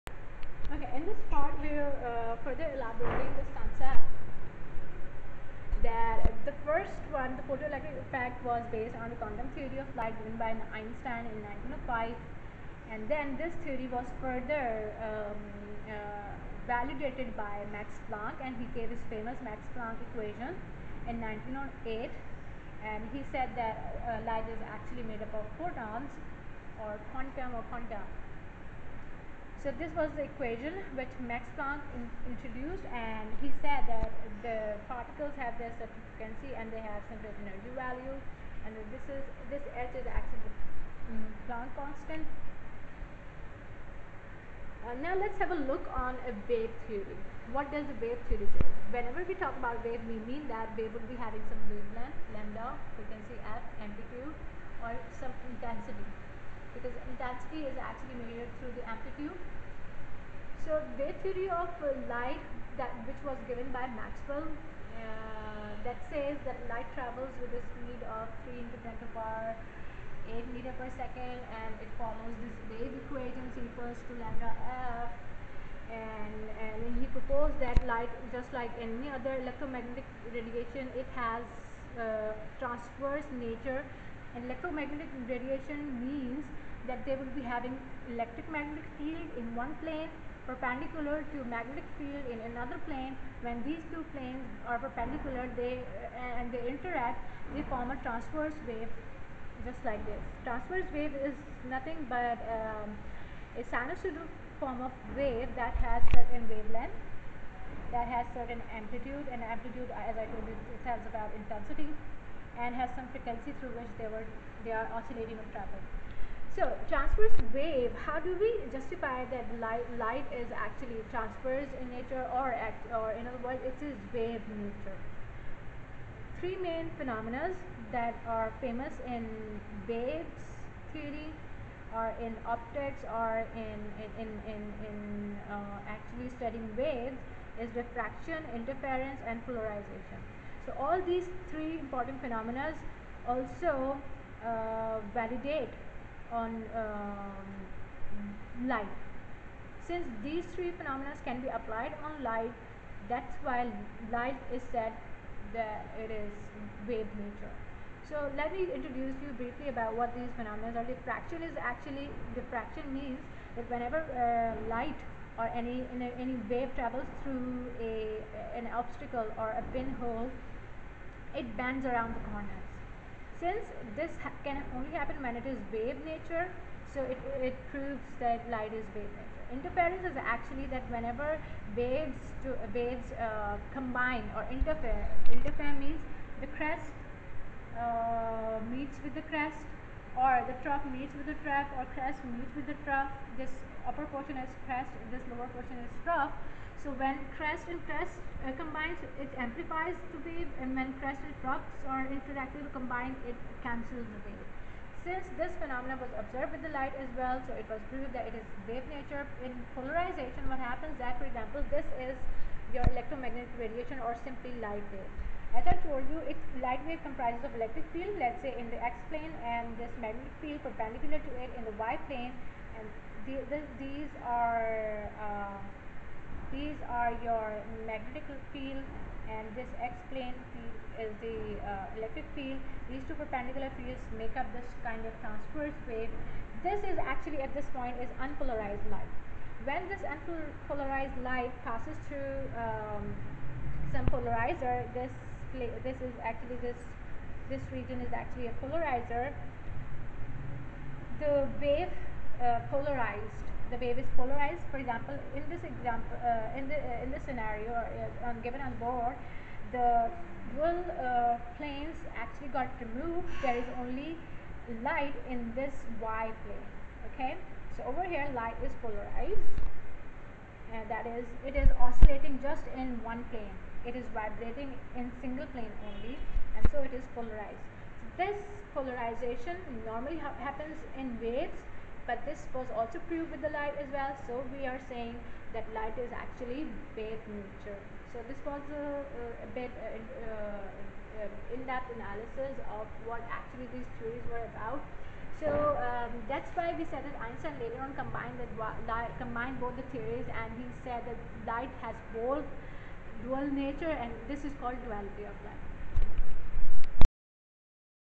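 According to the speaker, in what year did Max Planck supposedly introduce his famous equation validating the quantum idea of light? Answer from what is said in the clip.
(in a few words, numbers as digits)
1908.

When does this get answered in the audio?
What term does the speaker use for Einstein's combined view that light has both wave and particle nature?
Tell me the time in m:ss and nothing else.
5:04.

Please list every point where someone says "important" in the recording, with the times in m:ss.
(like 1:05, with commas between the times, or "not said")
2:21.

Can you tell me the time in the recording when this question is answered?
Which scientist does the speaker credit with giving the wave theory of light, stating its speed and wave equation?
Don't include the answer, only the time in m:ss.
1:03.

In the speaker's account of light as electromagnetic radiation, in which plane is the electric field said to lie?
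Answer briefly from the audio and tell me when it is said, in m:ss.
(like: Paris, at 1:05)
x-plane, at 3:38.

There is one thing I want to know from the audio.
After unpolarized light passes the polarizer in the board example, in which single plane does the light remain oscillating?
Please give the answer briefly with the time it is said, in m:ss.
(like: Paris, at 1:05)
y plane, at 4:26.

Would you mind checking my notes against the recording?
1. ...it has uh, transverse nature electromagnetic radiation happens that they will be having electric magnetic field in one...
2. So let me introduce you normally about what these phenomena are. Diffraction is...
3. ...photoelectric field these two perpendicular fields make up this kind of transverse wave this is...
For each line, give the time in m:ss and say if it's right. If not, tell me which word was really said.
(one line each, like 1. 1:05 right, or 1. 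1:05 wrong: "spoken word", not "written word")
1. 1:20 wrong: "means", not "happens"
2. 2:38 wrong: "briefly", not "normally"
3. 3:51 wrong: "electric", not "photoelectric".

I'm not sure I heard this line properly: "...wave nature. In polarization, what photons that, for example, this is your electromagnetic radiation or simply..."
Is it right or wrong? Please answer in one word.
wrong.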